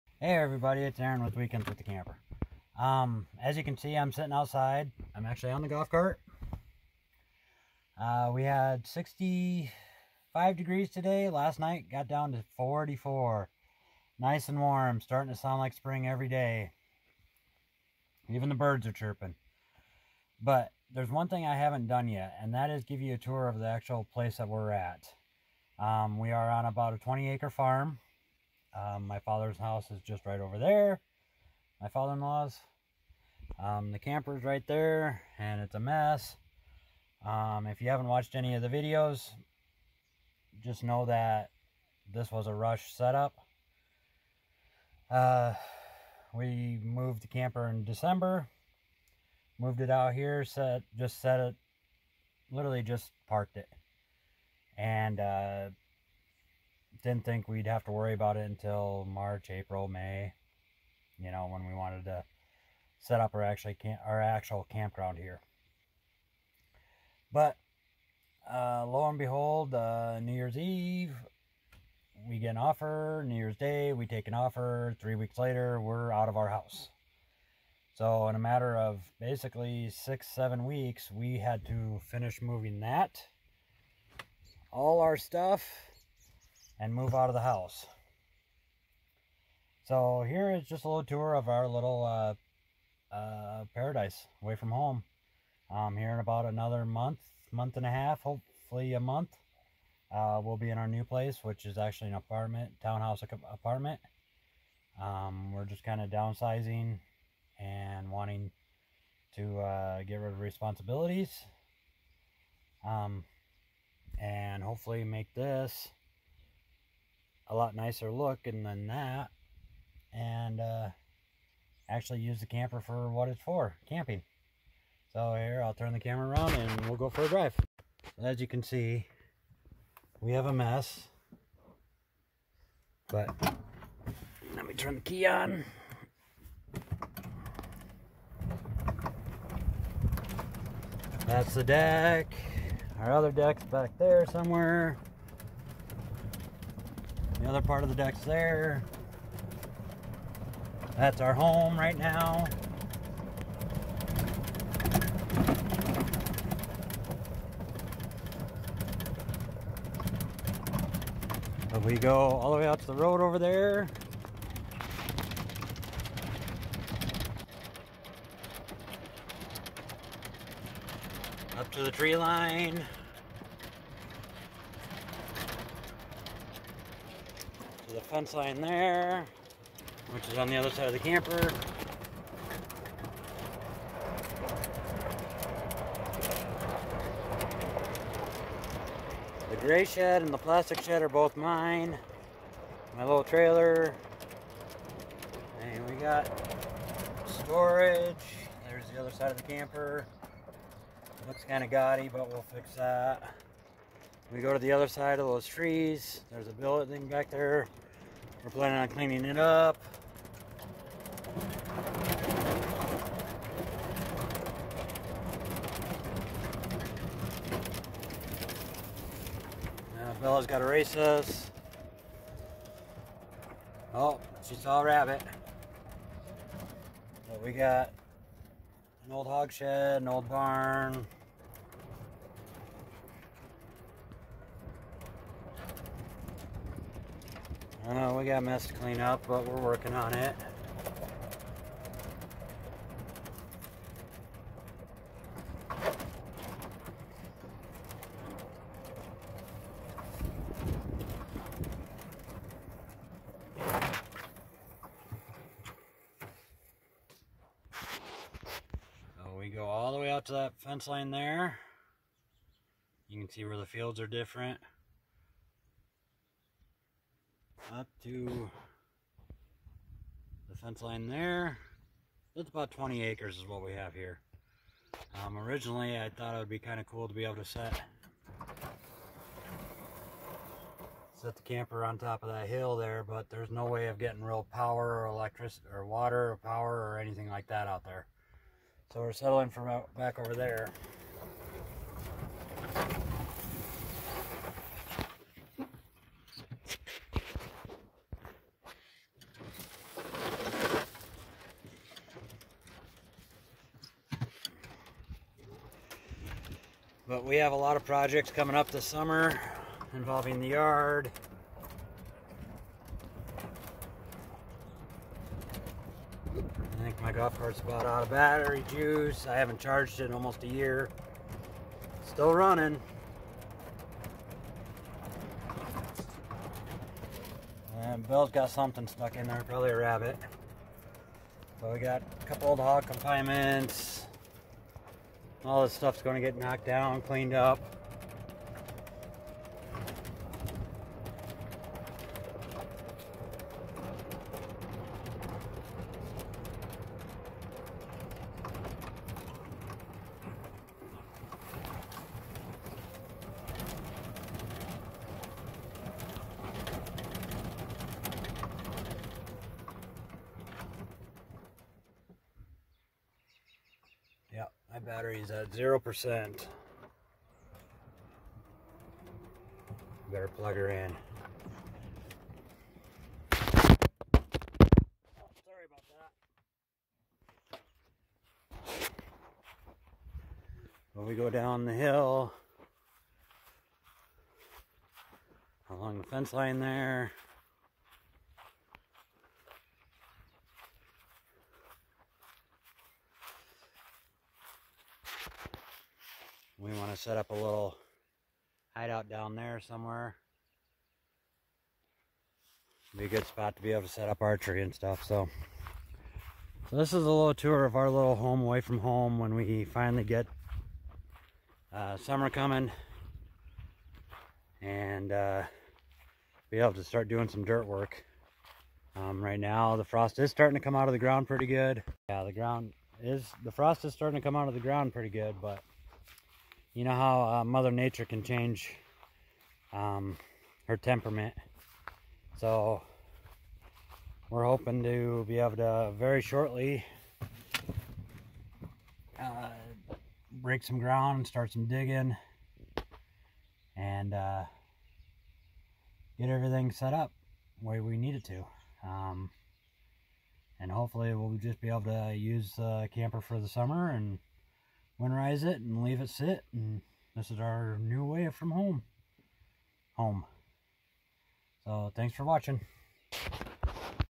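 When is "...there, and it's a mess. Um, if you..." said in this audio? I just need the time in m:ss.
0:34.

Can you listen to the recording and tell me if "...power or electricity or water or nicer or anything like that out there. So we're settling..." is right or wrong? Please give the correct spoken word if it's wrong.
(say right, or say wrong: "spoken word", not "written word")
wrong: "power", not "nicer".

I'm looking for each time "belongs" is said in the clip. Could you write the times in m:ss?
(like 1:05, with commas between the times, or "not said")
not said.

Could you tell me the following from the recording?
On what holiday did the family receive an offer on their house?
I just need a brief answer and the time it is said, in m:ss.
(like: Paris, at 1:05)
New Year's Eve, at 1:10.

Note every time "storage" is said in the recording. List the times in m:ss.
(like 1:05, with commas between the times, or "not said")
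3:17.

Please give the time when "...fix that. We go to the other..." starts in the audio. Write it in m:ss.
3:22.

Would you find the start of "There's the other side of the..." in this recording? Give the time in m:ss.
3:18.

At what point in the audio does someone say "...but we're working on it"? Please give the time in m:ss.
3:59.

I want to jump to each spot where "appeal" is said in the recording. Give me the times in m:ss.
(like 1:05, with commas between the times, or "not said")
not said.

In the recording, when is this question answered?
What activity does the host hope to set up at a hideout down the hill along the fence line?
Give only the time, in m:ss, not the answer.
6:44.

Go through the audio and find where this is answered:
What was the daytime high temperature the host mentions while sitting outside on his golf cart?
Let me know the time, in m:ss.
0:08.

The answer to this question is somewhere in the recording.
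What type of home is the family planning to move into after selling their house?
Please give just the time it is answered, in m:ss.
1:42.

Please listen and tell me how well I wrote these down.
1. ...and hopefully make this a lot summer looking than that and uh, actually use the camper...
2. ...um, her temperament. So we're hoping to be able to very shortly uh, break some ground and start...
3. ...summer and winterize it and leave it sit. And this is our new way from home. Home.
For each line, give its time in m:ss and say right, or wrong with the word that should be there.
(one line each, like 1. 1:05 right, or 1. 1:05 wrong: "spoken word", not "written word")
1. 1:54 wrong: "nicer", not "summer"
2. 7:09 right
3. 7:33 right.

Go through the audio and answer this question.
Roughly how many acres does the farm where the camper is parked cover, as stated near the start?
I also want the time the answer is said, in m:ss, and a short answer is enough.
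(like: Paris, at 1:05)
20 acres, at 0:26.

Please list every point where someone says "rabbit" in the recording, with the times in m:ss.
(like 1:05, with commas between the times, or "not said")
3:44, 5:29.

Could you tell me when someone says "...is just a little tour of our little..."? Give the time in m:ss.
1:30.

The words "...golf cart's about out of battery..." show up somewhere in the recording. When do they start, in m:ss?
5:17.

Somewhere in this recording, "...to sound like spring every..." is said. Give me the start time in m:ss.
0:15.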